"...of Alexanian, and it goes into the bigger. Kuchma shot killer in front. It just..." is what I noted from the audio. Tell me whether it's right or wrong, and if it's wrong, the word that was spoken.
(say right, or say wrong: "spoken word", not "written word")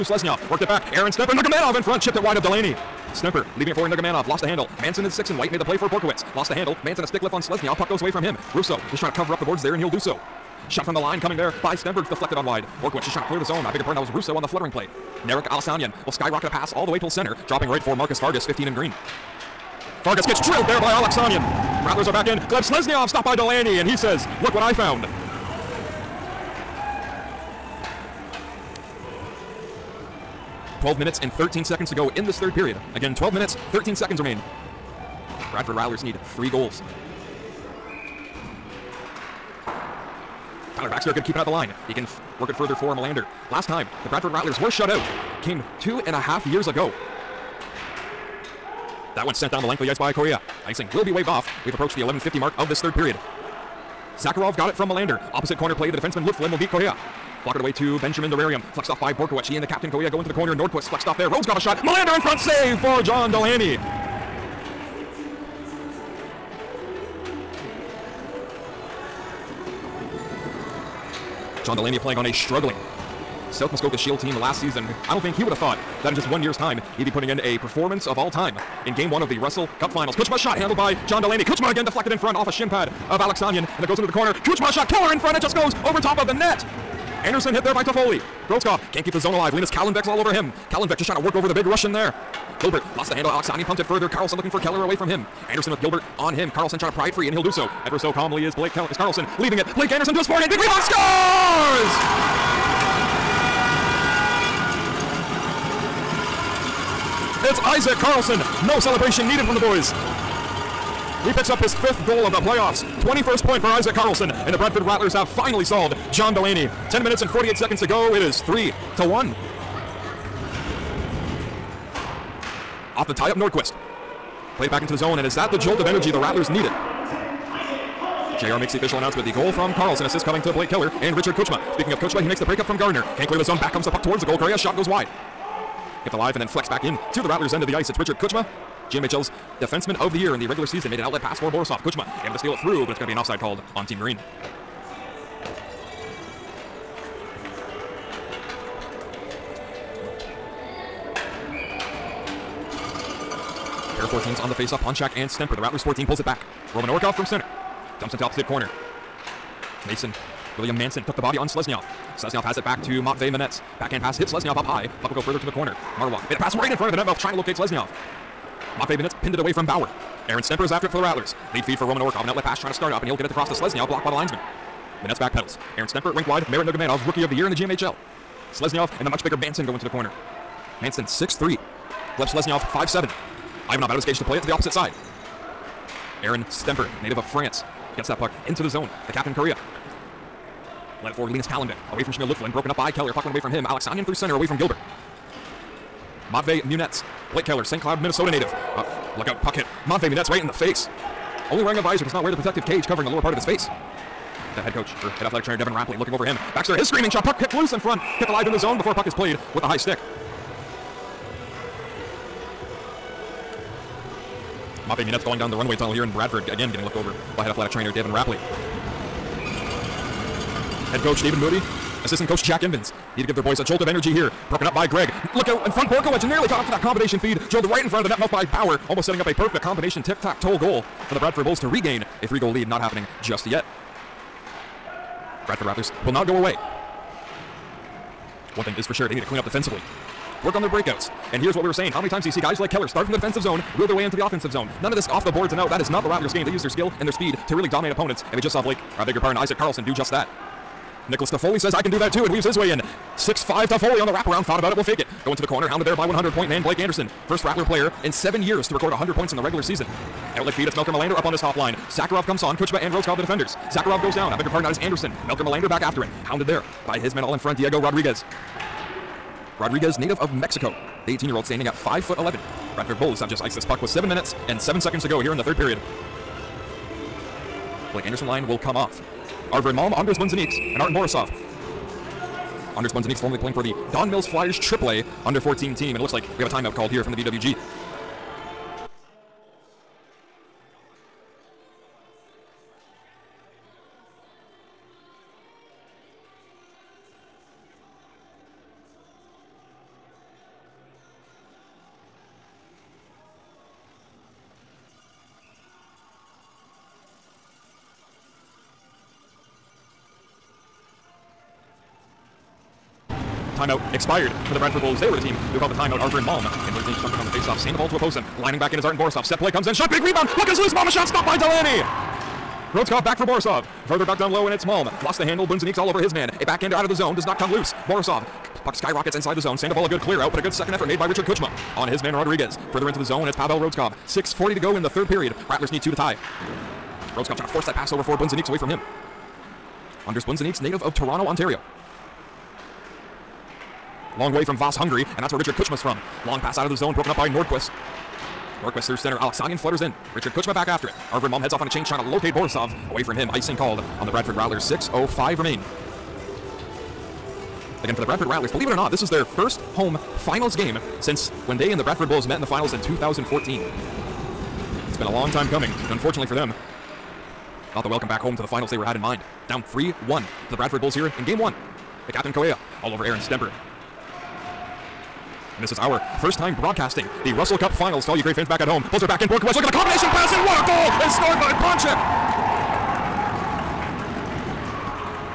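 wrong: "corner", not "bigger".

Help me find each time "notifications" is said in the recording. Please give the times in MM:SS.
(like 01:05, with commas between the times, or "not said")
not said.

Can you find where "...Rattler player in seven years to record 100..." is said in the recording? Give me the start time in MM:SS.
04:17.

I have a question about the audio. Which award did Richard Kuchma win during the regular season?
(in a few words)
Defenseman of the Year.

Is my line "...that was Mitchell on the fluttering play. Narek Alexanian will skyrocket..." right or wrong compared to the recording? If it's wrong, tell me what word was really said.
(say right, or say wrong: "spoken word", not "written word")
wrong: "Russo", not "Mitchell".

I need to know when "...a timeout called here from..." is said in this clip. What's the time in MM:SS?
04:46.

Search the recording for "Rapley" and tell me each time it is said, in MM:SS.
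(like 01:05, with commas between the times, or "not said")
03:25, 03:38.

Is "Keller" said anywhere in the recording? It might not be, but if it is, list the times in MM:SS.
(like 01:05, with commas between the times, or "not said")
01:34, 02:10, 03:12, 03:17, 04:02.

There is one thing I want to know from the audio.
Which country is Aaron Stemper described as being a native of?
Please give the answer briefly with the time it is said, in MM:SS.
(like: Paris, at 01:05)
France, at 03:07.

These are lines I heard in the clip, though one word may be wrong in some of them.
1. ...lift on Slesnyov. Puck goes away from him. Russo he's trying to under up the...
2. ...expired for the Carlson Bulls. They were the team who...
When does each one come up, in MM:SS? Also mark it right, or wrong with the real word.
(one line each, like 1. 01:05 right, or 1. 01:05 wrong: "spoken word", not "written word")
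1. 00:07 wrong: "cover", not "under"
2. 05:13 wrong: "Bradford", not "Carlson".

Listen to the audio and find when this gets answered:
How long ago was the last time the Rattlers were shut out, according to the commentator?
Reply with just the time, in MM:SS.
00:45.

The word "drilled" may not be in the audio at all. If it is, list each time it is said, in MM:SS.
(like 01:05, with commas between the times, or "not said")
00:20, 03:47.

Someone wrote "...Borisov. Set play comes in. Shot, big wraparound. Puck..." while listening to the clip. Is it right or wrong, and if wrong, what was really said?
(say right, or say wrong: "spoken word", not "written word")
wrong: "rebound", not "wraparound".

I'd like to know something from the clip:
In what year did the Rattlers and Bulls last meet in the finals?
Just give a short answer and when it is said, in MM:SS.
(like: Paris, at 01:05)
2014, at 06:02.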